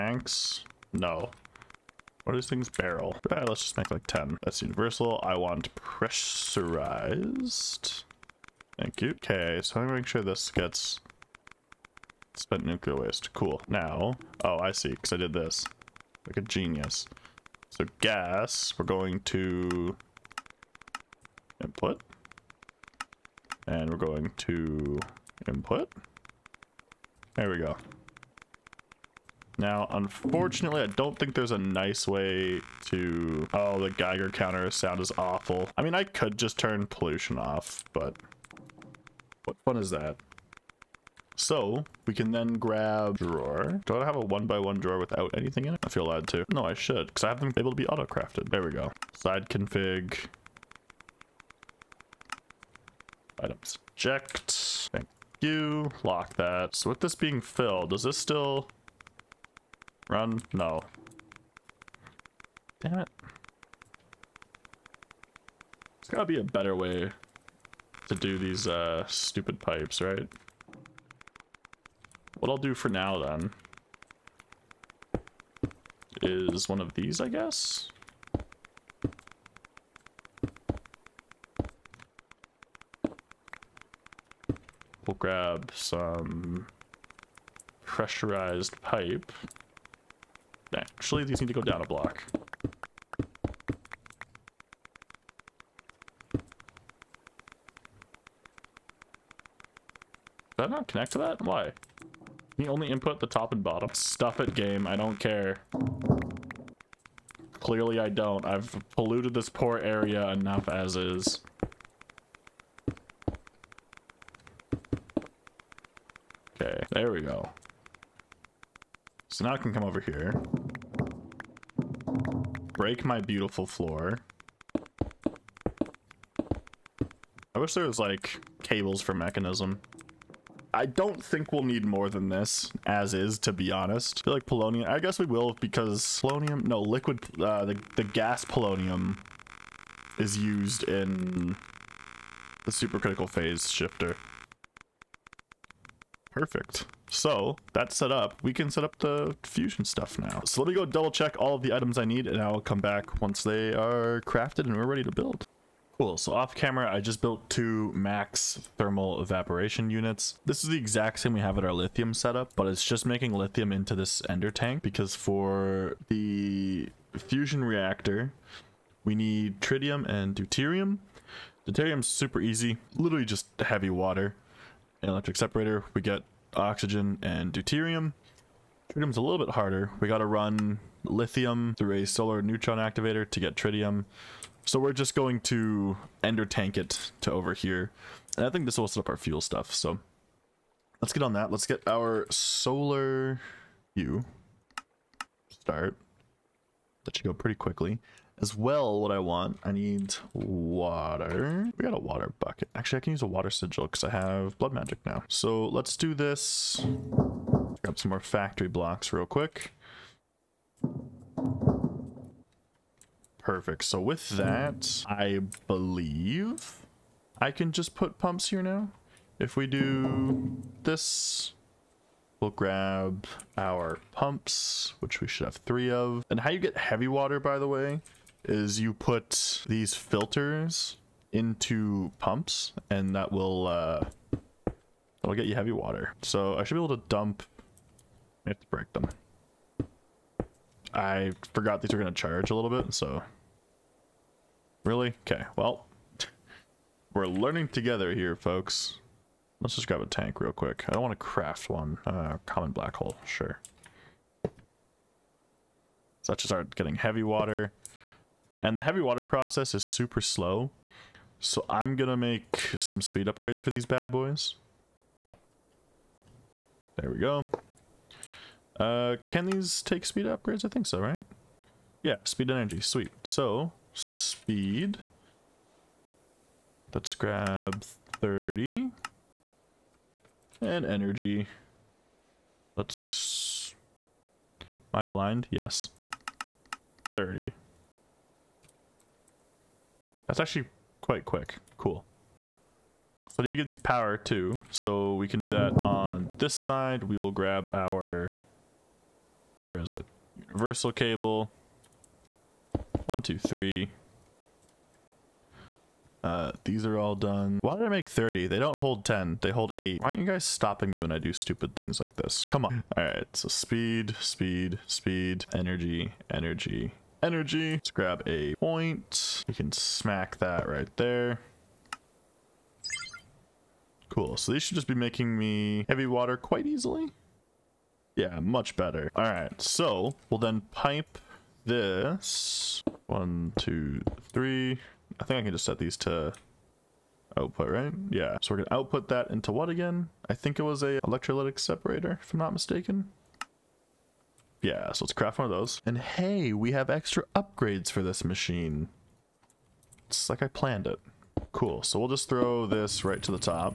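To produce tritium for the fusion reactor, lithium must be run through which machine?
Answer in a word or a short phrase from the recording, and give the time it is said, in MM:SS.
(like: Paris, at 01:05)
solar neutron activator, at 03:02.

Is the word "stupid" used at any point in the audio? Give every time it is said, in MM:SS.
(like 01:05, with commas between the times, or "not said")
01:09, 05:11.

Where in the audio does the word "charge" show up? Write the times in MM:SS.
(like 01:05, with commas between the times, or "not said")
04:02.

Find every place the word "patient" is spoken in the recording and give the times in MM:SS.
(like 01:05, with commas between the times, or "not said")
not said.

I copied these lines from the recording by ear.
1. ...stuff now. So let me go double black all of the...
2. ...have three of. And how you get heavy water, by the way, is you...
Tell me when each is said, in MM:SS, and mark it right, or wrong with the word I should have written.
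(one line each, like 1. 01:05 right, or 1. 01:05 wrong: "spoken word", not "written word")
1. 02:29 wrong: "check", not "black"
2. 03:45 right.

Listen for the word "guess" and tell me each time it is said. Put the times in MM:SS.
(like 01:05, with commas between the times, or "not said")
01:17, 02:14.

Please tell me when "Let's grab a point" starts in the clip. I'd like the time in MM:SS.
05:17.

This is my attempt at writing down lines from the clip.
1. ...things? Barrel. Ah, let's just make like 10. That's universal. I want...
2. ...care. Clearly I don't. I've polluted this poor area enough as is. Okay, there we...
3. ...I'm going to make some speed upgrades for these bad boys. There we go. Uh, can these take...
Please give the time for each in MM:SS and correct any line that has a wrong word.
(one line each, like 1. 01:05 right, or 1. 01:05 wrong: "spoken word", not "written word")
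1. 00:02 right
2. 01:45 right
3. 04:21 right.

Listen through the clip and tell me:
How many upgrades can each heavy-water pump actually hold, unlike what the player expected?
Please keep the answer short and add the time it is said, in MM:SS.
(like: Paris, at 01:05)
8, at 05:09.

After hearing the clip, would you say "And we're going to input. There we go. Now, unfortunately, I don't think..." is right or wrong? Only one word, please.
right.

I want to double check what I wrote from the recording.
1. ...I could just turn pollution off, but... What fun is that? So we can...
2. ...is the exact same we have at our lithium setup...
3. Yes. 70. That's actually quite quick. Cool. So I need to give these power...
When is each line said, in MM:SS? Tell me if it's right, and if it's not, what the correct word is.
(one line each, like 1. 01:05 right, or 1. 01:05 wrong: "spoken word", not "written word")
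1. 00:35 right
2. 02:40 right
3. 04:45 wrong: "30", not "70".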